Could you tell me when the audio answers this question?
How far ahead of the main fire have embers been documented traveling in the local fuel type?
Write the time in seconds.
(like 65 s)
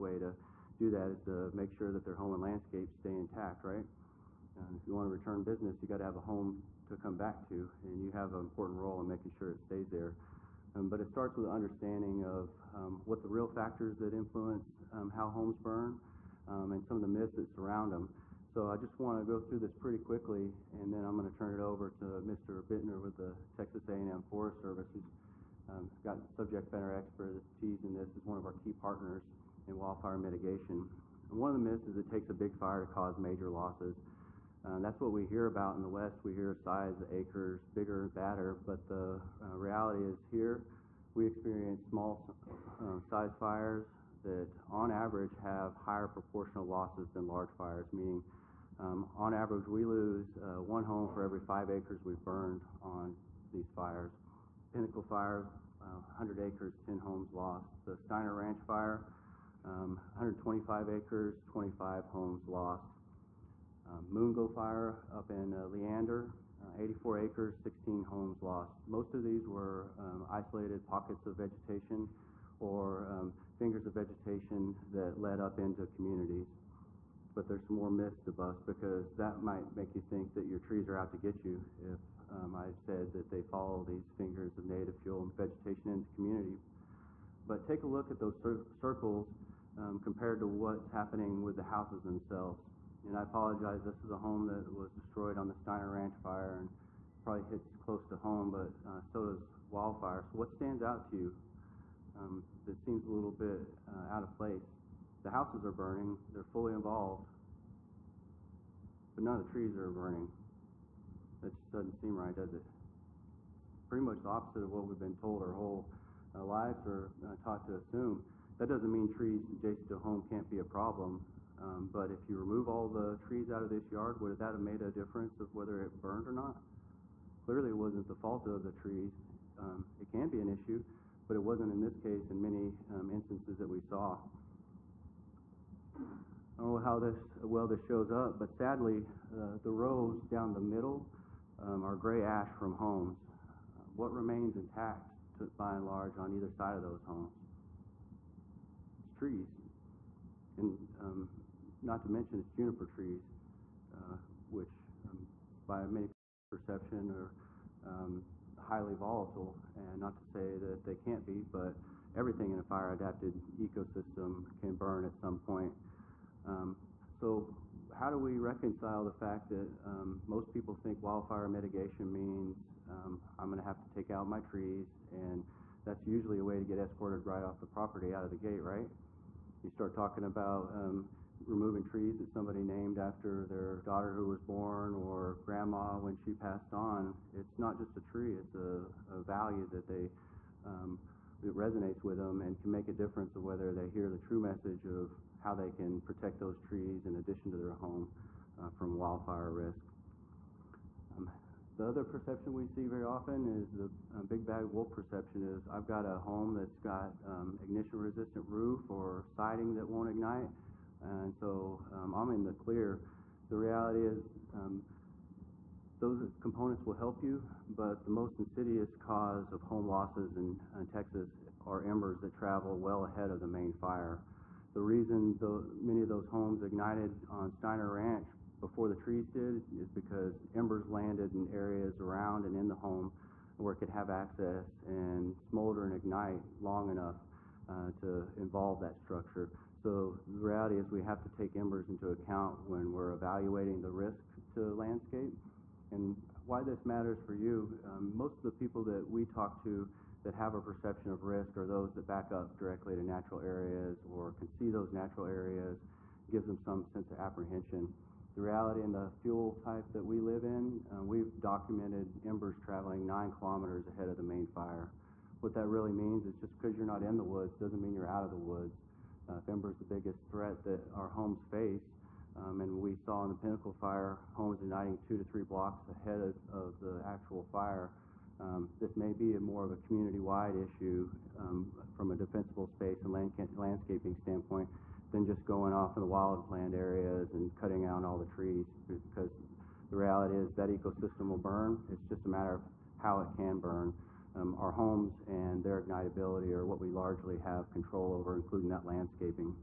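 263 s.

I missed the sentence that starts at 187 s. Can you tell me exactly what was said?
It's not just a tree, it's a, a value that they.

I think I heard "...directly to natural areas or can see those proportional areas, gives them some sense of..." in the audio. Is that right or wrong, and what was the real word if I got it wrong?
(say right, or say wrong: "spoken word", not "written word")
wrong: "natural", not "proportional".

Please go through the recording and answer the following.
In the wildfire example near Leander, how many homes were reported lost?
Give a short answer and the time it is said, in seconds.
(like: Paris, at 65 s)
16, at 67 s.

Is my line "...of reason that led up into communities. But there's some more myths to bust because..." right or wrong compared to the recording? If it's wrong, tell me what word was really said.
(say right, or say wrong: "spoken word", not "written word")
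wrong: "vegetation", not "reason".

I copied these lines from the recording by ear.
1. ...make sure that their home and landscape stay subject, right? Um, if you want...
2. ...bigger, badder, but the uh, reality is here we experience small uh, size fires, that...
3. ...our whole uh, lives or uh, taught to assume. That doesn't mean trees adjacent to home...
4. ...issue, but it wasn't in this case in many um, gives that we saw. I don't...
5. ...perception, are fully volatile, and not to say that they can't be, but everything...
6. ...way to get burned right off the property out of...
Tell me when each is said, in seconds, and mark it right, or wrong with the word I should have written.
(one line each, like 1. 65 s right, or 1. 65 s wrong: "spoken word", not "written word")
1. 1 s wrong: "intact", not "subject"
2. 37 s right
3. 115 s right
4. 130 s wrong: "instances", not "gives"
5. 156 s wrong: "highly", not "fully"
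6. 176 s wrong: "escorted", not "burned".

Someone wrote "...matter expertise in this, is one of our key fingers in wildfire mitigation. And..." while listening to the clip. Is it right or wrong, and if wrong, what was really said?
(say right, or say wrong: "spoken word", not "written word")
wrong: "partners", not "fingers".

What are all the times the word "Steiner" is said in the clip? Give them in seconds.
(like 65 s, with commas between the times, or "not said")
57 s, 95 s, 227 s.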